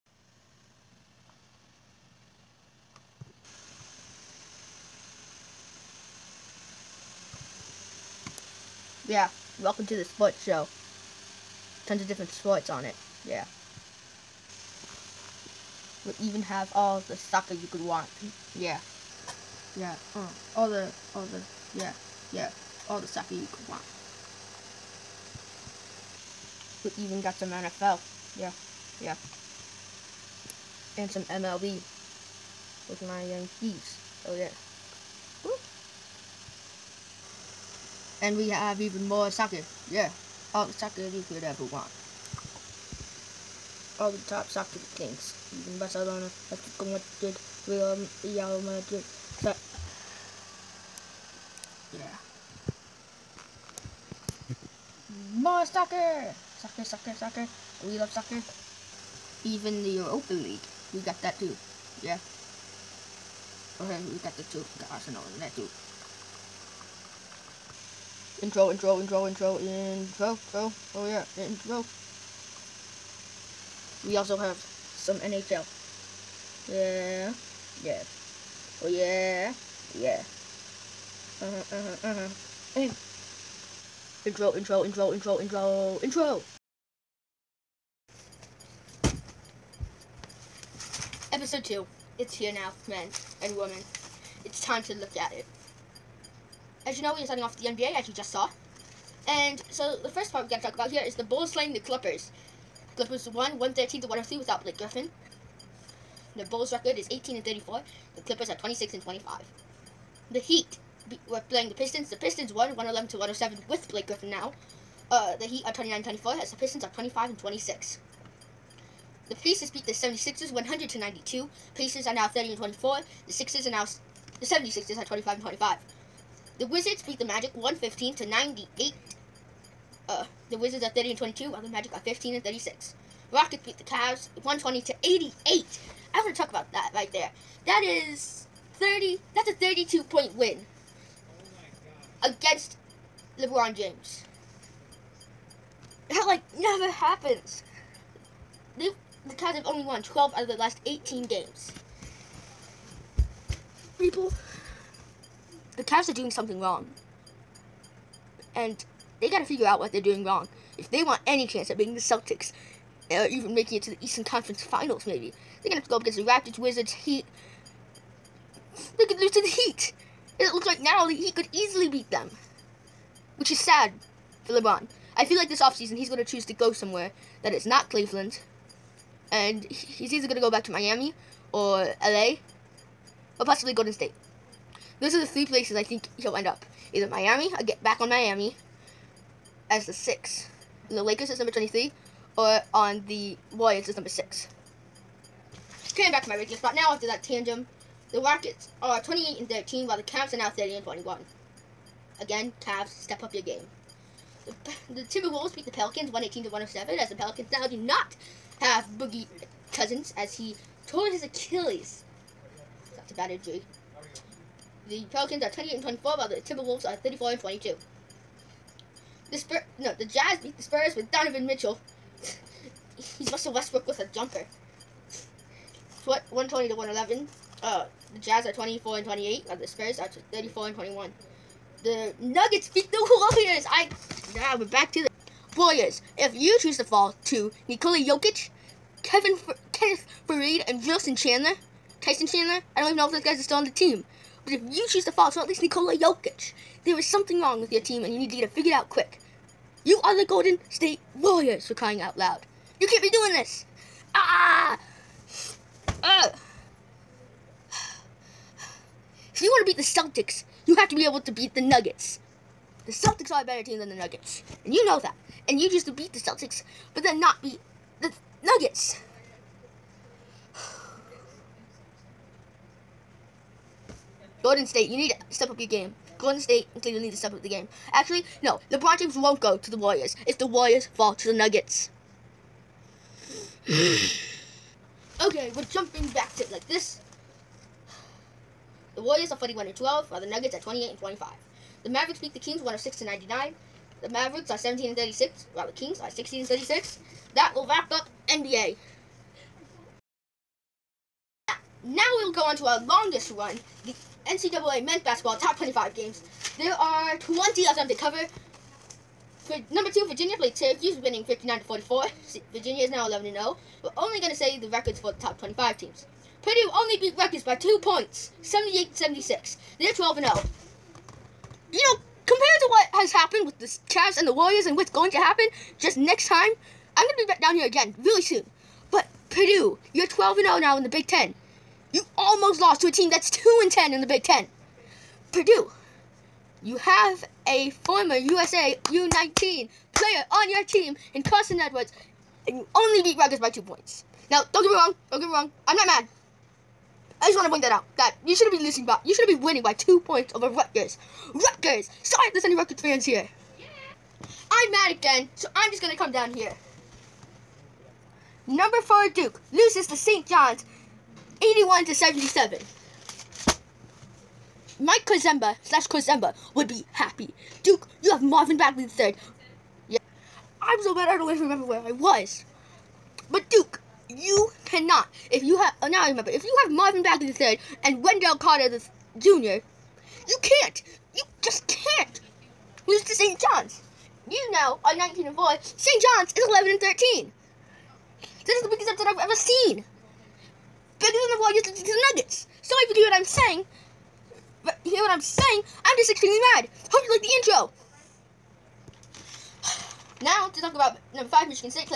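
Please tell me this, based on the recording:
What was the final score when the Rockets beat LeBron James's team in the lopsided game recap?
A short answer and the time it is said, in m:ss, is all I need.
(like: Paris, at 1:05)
120 to 88, at 2:14.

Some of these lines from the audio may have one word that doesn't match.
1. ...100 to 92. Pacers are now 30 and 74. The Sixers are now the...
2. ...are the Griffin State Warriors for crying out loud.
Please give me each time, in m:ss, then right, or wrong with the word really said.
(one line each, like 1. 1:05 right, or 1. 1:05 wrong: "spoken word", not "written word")
1. 2:00 wrong: "24", not "74"
2. 4:10 wrong: "Golden", not "Griffin".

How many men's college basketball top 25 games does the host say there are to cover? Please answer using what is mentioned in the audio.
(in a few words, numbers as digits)
20.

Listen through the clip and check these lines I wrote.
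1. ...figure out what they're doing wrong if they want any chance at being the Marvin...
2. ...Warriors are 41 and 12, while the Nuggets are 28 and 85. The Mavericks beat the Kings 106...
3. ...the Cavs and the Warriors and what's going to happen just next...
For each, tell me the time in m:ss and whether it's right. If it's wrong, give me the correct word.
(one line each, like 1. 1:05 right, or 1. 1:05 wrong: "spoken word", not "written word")
1. 2:39 wrong: "Celtics", not "Marvin"
2. 4:49 wrong: "25", not "85"
3. 5:23 right.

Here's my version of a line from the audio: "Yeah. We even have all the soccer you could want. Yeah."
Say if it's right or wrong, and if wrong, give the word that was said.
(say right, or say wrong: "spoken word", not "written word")
right.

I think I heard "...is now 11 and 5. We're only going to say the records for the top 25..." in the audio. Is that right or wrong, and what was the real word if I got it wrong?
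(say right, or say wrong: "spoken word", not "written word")
wrong: "0", not "5".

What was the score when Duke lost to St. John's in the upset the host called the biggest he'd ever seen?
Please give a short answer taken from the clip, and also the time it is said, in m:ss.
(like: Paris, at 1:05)
81 to 77, at 6:01.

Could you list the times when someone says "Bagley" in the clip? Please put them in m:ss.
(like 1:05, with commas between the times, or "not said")
6:08, 6:17.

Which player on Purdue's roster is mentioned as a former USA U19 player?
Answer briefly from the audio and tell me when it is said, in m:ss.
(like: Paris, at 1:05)
Carson Edwards, at 5:41.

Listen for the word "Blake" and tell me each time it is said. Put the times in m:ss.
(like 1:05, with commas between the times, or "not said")
1:44, 1:53.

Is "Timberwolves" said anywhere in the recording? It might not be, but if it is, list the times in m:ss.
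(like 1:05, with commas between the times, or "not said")
3:25, 3:36.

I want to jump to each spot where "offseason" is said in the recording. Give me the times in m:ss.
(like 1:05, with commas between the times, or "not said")
2:55.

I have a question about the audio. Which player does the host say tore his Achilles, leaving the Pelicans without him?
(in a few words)
Boogie Cousins.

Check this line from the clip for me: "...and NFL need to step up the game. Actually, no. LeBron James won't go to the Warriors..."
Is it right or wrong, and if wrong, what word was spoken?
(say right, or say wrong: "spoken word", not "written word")
wrong: "Cleveland", not "NFL".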